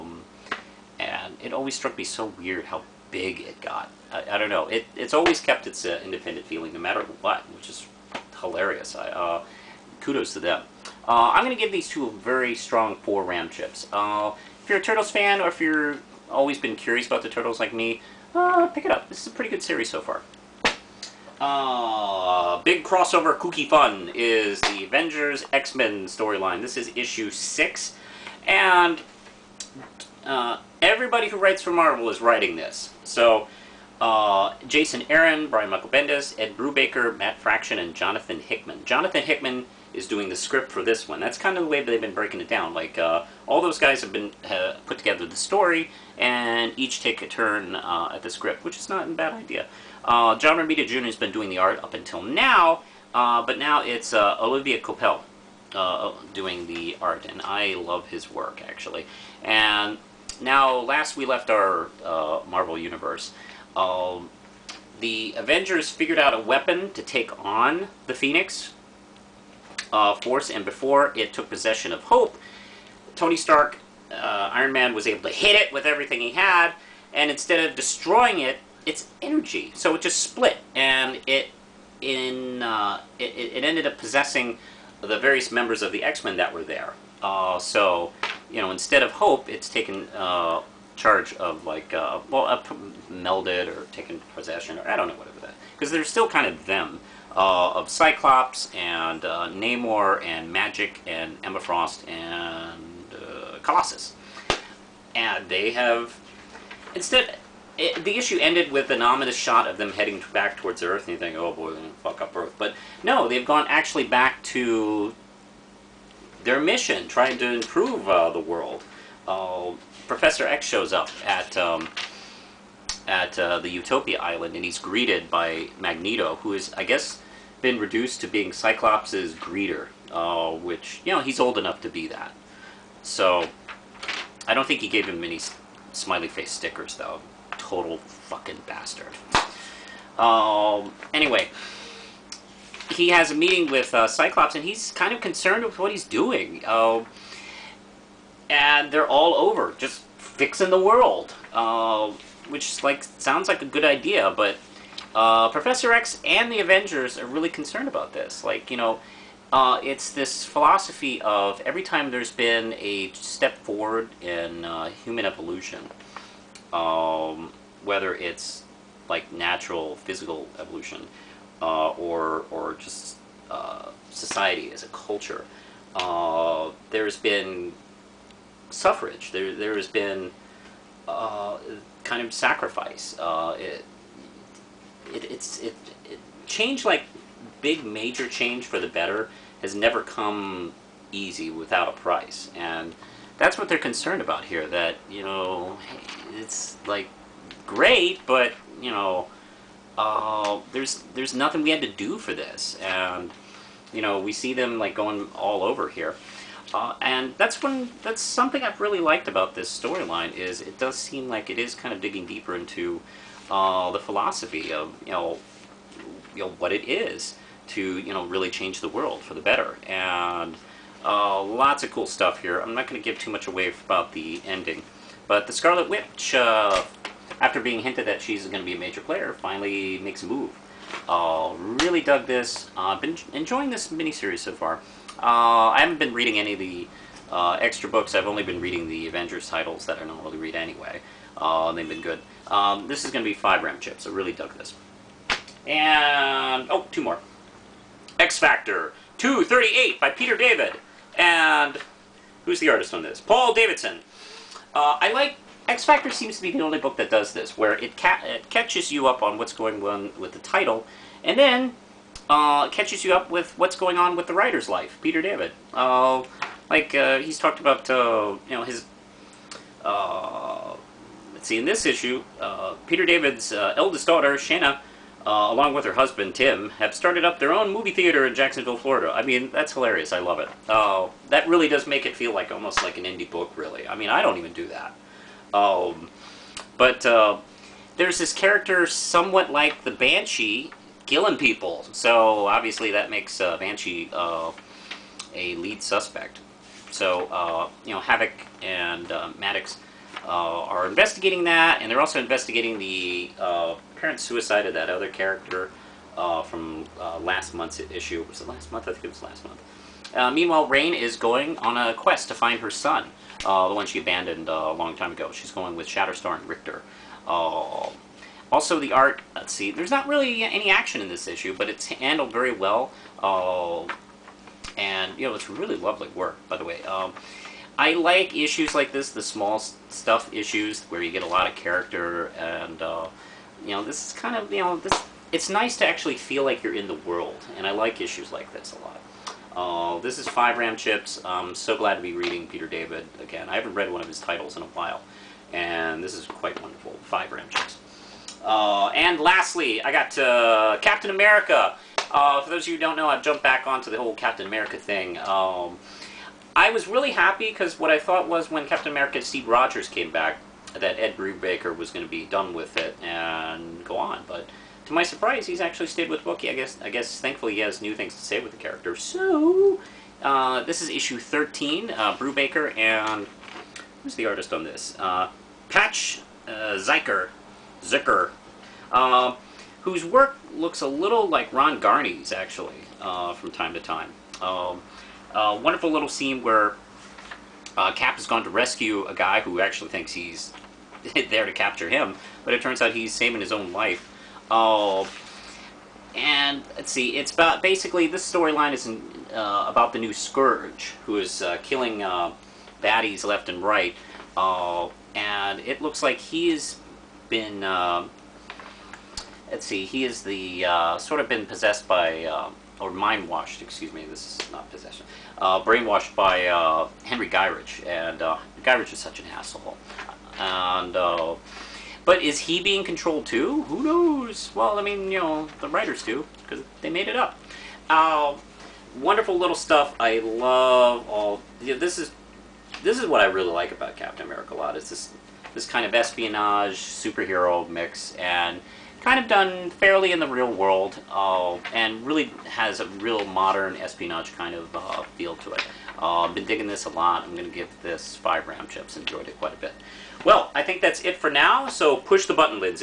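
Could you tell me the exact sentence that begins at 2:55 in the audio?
Uh, there's been suffrage, there, there has been uh, kind of sacrifice.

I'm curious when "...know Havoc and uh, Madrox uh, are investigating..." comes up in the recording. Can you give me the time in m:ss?
4:57.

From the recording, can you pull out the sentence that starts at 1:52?
But no, they've gone actually back to their mission, trying to improve uh, the world.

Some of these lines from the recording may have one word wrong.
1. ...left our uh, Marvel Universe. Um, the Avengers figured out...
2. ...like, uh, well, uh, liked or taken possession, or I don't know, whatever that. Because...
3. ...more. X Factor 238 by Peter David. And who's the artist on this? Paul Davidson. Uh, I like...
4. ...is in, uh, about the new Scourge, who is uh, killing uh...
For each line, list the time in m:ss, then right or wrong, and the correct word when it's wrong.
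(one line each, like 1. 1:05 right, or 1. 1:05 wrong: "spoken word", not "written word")
1. 1:01 right
2. 1:31 wrong: "melded", not "liked"
3. 4:07 right
4. 6:38 right.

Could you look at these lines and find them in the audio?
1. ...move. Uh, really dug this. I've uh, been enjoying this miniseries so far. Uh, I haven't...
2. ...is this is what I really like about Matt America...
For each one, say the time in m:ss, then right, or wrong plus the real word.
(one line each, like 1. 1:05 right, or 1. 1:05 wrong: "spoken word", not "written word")
1. 3:50 right
2. 7:11 wrong: "Captain", not "Matt".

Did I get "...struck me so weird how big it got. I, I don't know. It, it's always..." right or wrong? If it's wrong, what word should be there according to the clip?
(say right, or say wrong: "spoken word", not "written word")
right.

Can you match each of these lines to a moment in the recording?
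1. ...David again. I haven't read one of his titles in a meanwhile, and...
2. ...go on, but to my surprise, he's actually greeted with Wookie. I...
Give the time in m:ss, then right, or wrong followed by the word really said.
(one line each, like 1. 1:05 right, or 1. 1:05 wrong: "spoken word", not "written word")
1. 5:42 wrong: "while", not "meanwhile"
2. 6:03 wrong: "stayed", not "greeted".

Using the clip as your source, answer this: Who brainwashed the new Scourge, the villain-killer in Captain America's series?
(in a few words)
Henry Gyrich.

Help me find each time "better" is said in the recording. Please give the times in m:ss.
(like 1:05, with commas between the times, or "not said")
3:08, 3:39.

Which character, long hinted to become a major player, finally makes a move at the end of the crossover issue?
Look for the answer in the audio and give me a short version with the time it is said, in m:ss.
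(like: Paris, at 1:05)
The Scarlet Witch, at 3:45.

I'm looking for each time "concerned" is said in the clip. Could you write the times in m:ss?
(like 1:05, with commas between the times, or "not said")
2:25, 2:37, 3:13.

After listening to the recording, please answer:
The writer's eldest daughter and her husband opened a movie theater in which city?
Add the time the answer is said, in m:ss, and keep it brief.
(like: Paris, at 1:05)
Jacksonville, Florida, at 4:38.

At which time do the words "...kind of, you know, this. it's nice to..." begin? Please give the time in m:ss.
5:34.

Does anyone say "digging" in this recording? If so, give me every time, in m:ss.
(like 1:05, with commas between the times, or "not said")
3:32, 7:26.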